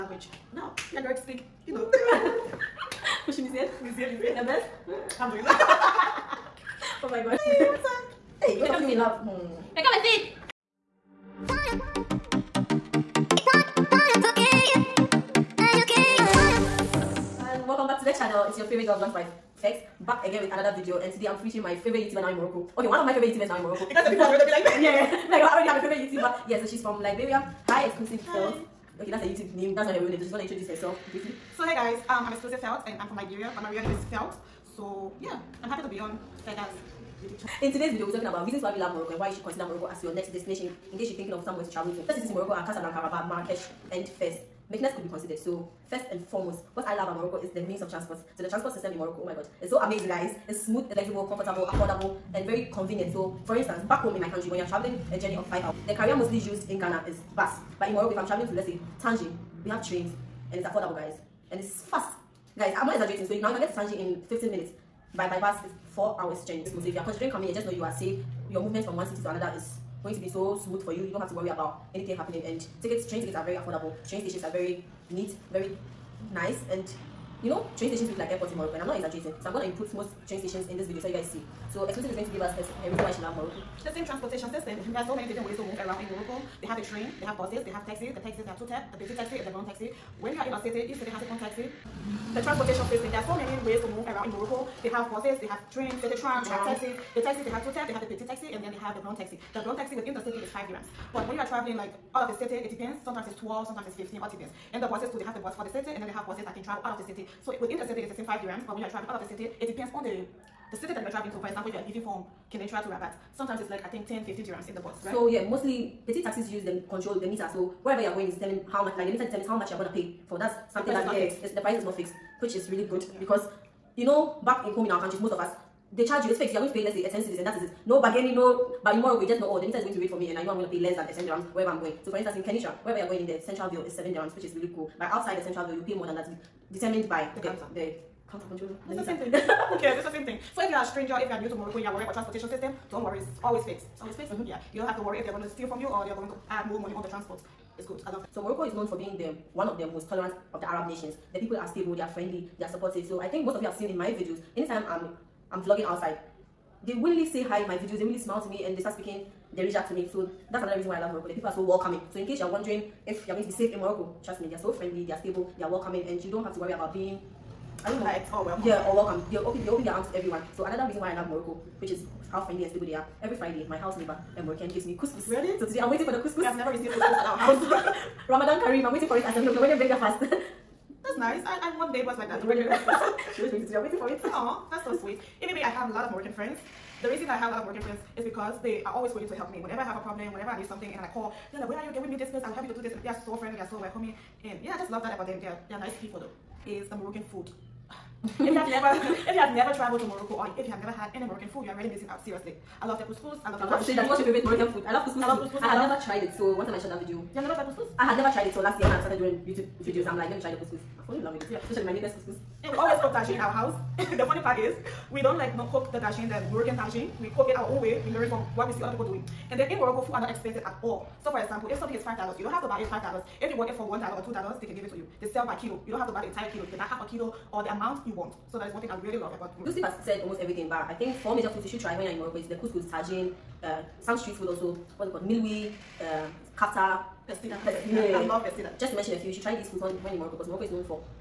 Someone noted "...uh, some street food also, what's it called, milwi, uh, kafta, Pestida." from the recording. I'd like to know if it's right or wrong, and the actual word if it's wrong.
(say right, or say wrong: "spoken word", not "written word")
right.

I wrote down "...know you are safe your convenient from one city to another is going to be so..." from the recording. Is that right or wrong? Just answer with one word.
wrong.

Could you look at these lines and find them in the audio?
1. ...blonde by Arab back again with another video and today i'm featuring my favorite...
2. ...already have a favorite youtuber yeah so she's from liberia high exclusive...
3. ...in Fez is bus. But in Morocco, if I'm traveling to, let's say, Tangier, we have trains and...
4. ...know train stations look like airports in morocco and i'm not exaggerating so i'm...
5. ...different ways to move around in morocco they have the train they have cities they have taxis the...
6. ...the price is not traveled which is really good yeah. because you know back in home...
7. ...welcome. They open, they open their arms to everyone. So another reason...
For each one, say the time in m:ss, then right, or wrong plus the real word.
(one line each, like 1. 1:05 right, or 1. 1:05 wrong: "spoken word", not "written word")
1. 0:18 wrong: "Fegs", not "Arab"
2. 0:25 right
3. 0:56 wrong: "Ghana", not "Fez"
4. 1:17 right
5. 1:25 wrong: "buses", not "cities"
6. 2:01 wrong: "fixed", not "traveled"
7. 2:48 right.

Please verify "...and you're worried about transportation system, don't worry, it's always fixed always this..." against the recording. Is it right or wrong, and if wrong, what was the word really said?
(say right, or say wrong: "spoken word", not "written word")
right.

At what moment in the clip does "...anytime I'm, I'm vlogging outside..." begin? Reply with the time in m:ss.
2:34.